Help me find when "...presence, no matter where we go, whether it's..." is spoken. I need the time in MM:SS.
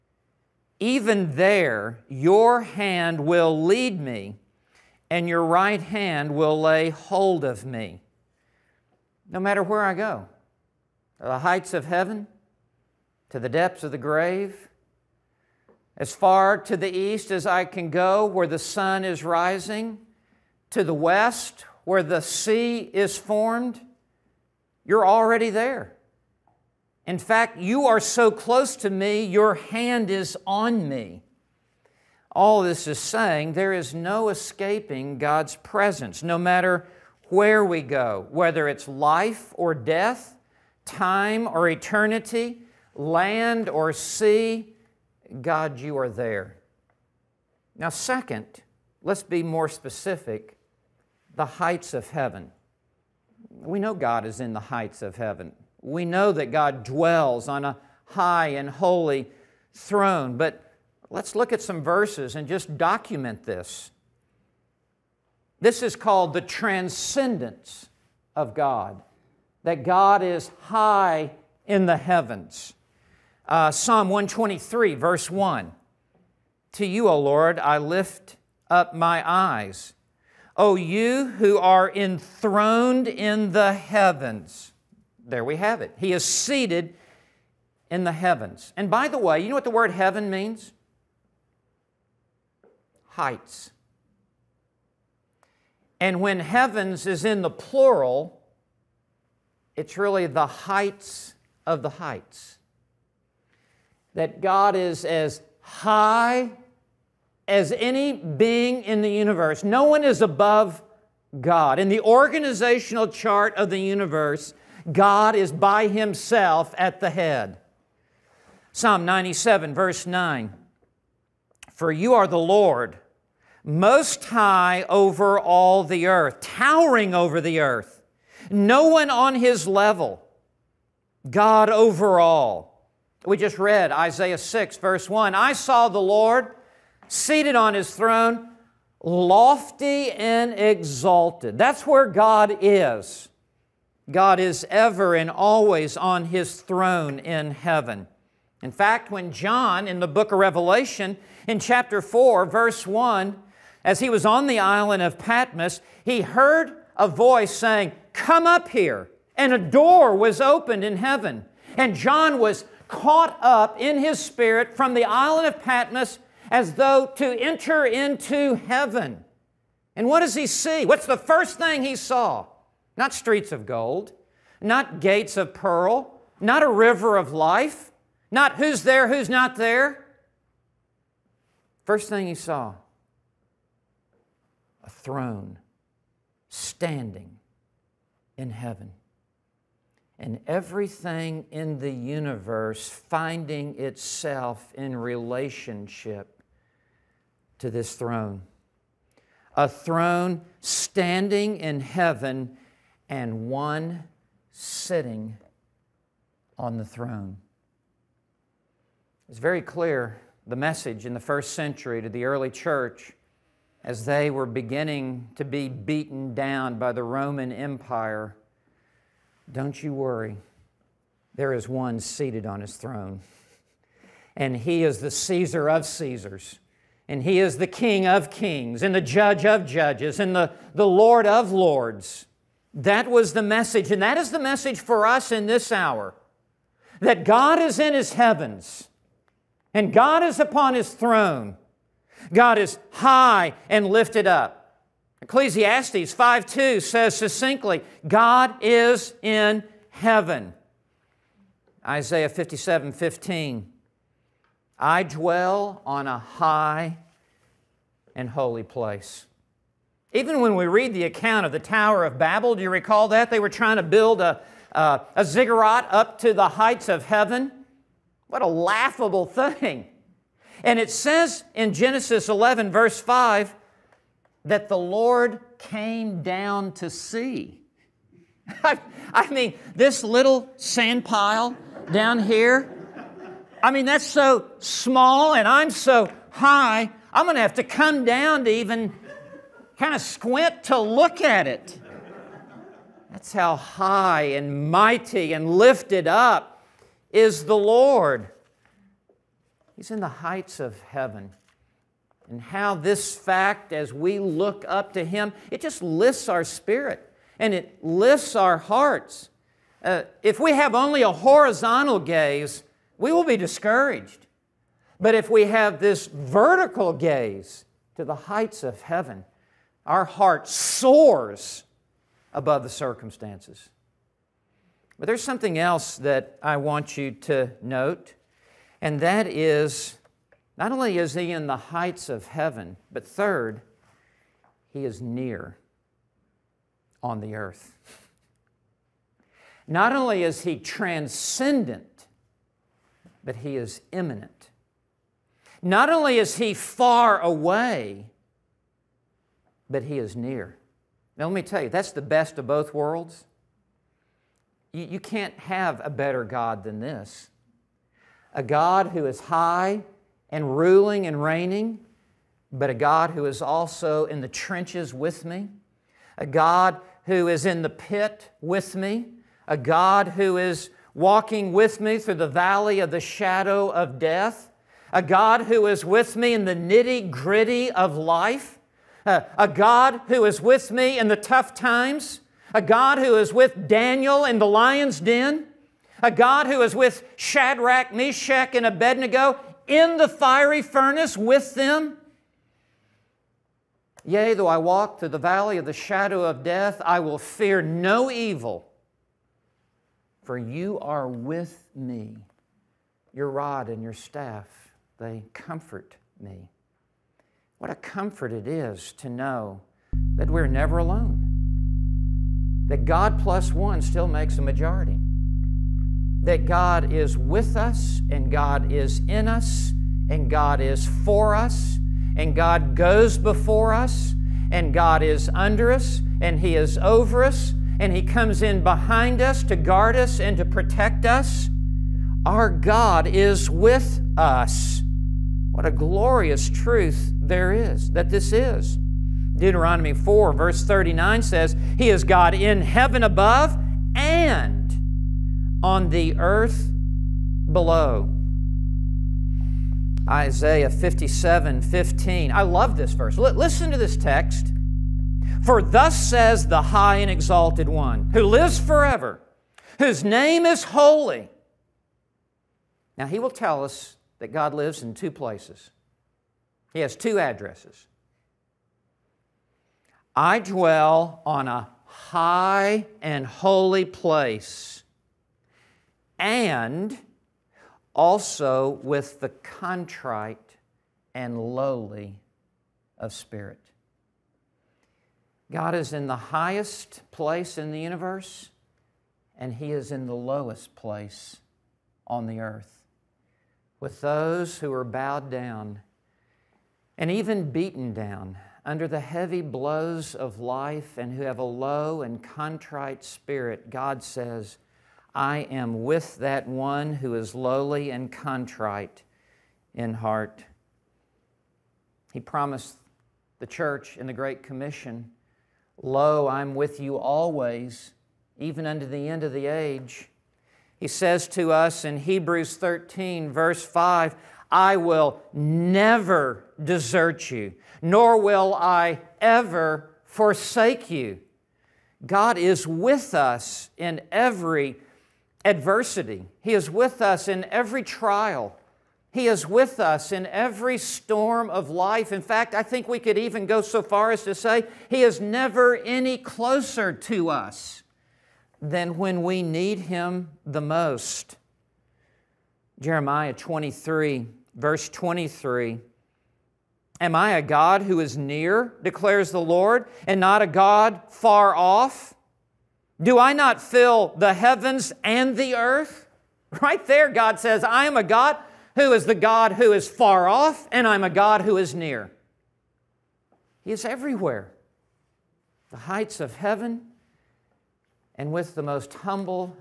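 00:35.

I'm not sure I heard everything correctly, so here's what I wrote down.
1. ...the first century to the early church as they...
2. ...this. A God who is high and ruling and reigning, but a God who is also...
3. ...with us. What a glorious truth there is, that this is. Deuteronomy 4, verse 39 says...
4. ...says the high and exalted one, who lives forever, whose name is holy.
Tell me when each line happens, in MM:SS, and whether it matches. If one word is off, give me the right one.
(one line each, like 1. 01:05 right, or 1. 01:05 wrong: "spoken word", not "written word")
1. 03:31 right
2. 05:56 right
3. 07:13 right
4. 07:35 right.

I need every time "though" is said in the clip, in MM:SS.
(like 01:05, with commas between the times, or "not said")
02:46, 06:34.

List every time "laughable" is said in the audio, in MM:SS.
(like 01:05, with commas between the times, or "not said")
04:28.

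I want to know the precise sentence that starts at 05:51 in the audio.
Now, let me tell you, that's the best of both worlds.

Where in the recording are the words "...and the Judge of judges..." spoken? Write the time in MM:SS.
03:48.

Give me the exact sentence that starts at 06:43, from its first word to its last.
Your rod and your staff, they comfort me.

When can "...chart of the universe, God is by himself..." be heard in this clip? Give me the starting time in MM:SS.
01:53.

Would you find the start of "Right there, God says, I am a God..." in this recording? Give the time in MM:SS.
09:26.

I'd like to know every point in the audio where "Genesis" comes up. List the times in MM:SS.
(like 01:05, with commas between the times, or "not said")
04:31.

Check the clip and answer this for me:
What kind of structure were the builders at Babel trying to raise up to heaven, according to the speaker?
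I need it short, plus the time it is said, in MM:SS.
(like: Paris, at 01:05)
A ziggurat, at 04:25.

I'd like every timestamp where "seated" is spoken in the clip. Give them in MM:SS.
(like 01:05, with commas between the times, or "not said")
01:26, 02:17, 03:41.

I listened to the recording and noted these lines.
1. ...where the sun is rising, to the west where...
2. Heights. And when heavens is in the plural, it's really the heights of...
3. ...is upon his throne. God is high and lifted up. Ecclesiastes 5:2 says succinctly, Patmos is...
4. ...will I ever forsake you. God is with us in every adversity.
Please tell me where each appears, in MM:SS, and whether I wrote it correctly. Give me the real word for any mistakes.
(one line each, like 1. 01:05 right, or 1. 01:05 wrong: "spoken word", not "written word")
1. 00:18 right
2. 01:33 right
3. 04:00 wrong: "God", not "Patmos"
4. 08:48 right.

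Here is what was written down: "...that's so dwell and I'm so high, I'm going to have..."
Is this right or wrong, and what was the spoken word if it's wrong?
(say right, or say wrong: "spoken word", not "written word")
wrong: "small", not "dwell".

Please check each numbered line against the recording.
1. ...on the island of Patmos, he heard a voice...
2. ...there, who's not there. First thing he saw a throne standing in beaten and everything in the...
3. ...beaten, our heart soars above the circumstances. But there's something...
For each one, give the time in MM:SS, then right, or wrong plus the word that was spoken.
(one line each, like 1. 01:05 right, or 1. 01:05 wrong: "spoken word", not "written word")
1. 02:34 right
2. 02:58 wrong: "heaven", not "beaten"
3. 05:18 wrong: "heaven", not "beaten".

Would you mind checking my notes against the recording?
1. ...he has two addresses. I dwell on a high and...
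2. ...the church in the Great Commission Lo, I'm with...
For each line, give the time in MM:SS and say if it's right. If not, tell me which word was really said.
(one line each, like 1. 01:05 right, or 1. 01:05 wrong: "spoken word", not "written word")
1. 07:46 right
2. 08:33 right.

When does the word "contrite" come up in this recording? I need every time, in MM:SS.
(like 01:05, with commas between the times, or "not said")
07:59, 08:22, 08:28.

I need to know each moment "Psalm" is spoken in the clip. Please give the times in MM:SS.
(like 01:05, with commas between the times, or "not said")
01:13, 01:58.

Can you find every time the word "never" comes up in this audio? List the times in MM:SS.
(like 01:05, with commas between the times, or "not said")
06:50, 08:45, 09:05.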